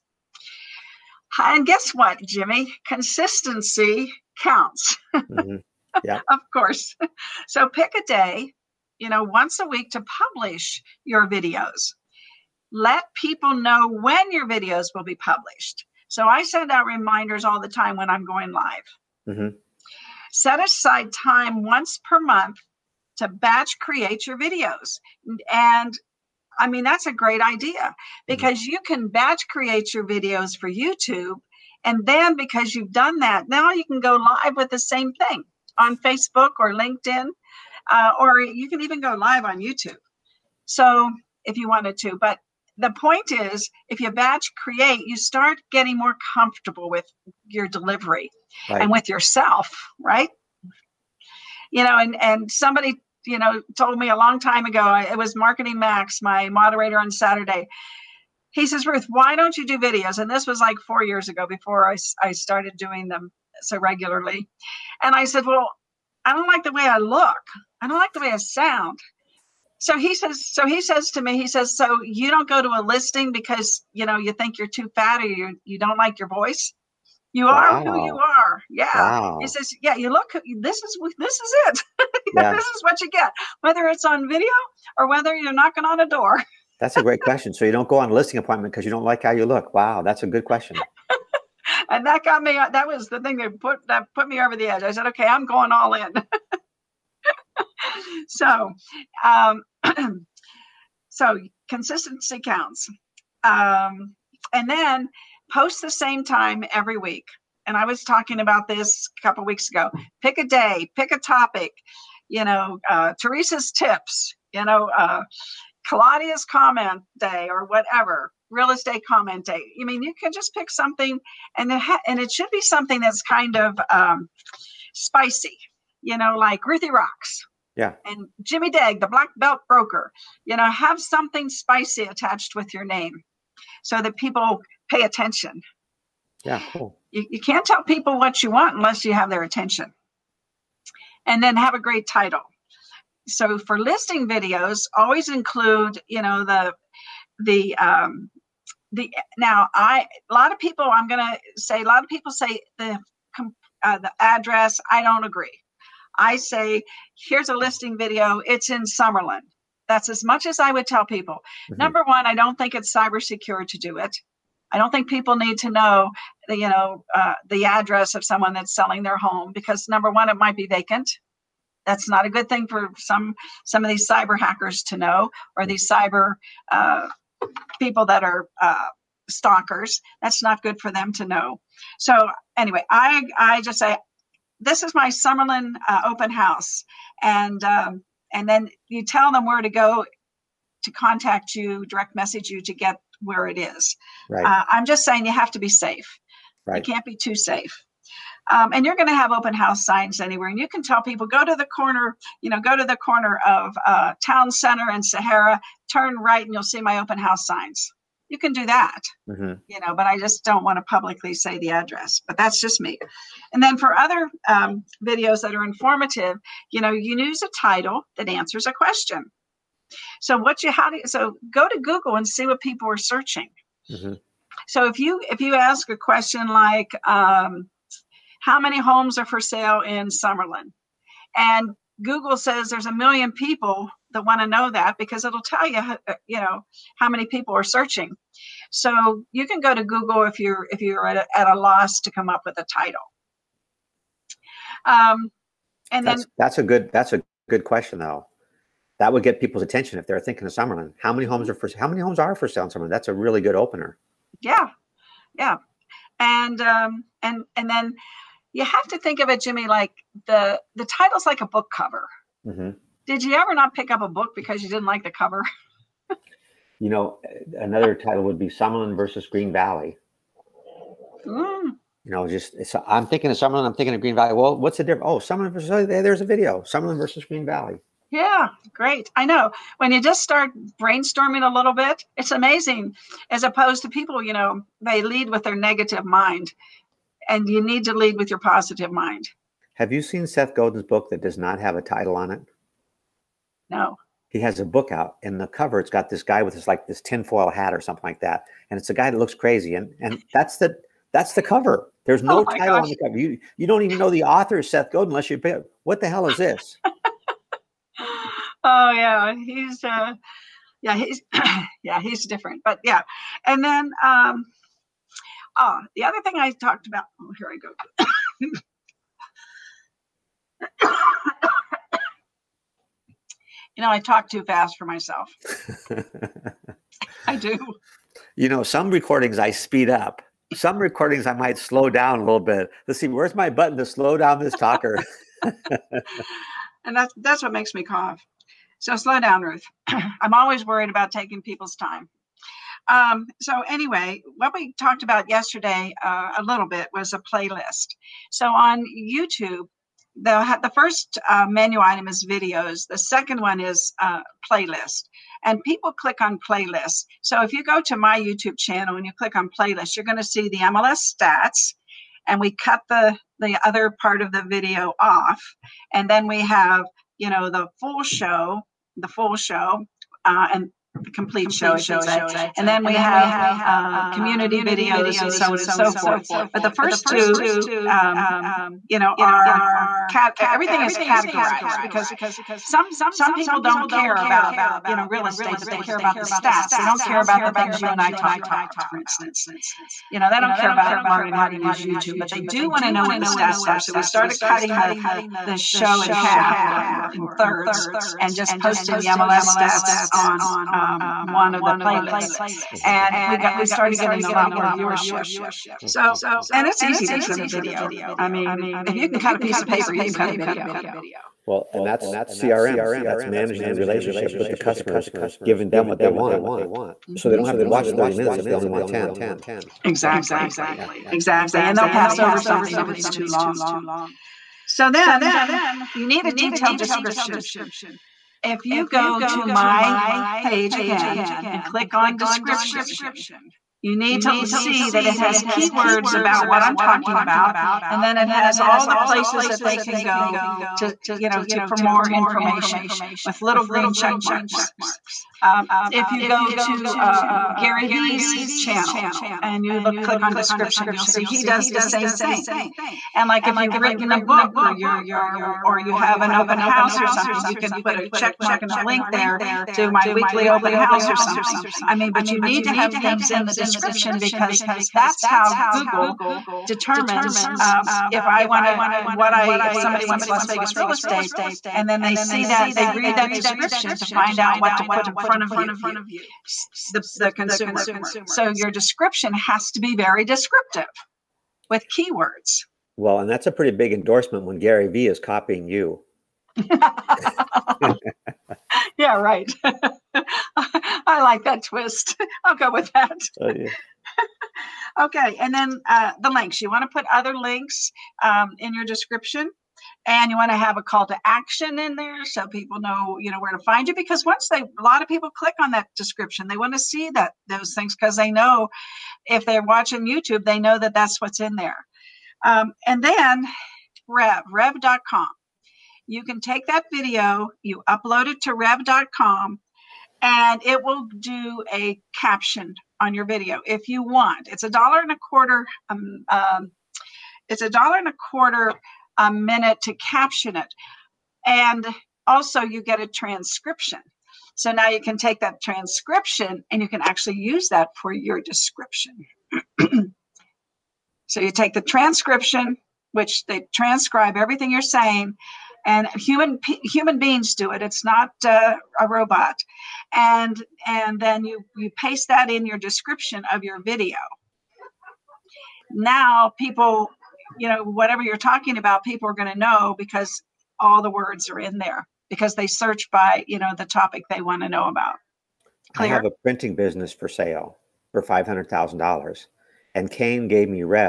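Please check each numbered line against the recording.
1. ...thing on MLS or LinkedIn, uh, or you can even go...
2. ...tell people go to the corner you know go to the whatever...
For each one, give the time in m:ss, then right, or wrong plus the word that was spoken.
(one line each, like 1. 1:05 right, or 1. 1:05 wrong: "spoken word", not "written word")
1. 0:35 wrong: "Facebook", not "MLS"
2. 3:20 wrong: "corner", not "whatever".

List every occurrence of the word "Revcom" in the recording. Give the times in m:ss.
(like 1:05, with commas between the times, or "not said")
8:34, 8:38.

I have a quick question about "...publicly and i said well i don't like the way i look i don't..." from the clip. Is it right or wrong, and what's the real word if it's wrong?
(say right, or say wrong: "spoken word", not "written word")
wrong: "regularly", not "publicly".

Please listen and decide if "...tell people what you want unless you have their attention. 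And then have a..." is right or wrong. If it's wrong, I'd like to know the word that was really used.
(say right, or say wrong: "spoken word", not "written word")
right.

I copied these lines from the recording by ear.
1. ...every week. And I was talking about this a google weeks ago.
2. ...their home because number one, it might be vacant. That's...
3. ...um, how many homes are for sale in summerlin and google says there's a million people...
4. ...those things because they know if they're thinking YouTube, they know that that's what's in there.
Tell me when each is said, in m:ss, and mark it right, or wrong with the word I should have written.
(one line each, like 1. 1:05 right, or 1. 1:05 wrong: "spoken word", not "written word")
1. 1:46 wrong: "couple", not "google"
2. 2:49 right
3. 3:47 right
4. 8:27 wrong: "watching", not "thinking".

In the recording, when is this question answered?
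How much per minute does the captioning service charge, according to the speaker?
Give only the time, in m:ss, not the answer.
8:47.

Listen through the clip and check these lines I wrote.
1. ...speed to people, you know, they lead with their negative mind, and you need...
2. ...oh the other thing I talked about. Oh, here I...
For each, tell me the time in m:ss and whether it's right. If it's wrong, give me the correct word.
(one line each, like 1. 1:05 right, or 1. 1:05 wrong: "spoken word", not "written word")
1. 4:43 wrong: "opposed", not "speed"
2. 5:15 right.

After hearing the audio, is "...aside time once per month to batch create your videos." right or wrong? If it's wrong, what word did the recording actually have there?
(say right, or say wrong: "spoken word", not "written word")
right.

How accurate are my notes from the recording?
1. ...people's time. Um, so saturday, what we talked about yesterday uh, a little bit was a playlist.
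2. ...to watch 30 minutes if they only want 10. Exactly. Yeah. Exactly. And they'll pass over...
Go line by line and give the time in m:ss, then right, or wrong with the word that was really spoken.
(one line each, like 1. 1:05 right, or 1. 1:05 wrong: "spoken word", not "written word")
1. 5:41 wrong: "anyway", not "saturday"
2. 6:57 right.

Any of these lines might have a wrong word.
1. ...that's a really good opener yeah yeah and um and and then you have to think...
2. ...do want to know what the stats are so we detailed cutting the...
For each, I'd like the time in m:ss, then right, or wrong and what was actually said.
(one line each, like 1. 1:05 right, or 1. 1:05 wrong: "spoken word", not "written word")
1. 4:12 right
2. 6:32 wrong: "started", not "detailed".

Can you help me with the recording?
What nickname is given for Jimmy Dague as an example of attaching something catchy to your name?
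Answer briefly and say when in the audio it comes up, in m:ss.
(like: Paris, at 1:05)
the black belt broker, at 2:08.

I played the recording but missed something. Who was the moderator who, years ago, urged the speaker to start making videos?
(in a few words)
Marketing Max.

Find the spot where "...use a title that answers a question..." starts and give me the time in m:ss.
3:37.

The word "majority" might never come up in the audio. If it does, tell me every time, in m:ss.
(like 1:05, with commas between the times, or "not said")
not said.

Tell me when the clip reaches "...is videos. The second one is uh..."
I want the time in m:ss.
5:52.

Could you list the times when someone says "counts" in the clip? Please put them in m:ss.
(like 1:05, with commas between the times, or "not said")
0:04, 1:42.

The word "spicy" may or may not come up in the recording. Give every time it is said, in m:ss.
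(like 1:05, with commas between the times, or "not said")
2:04, 2:11.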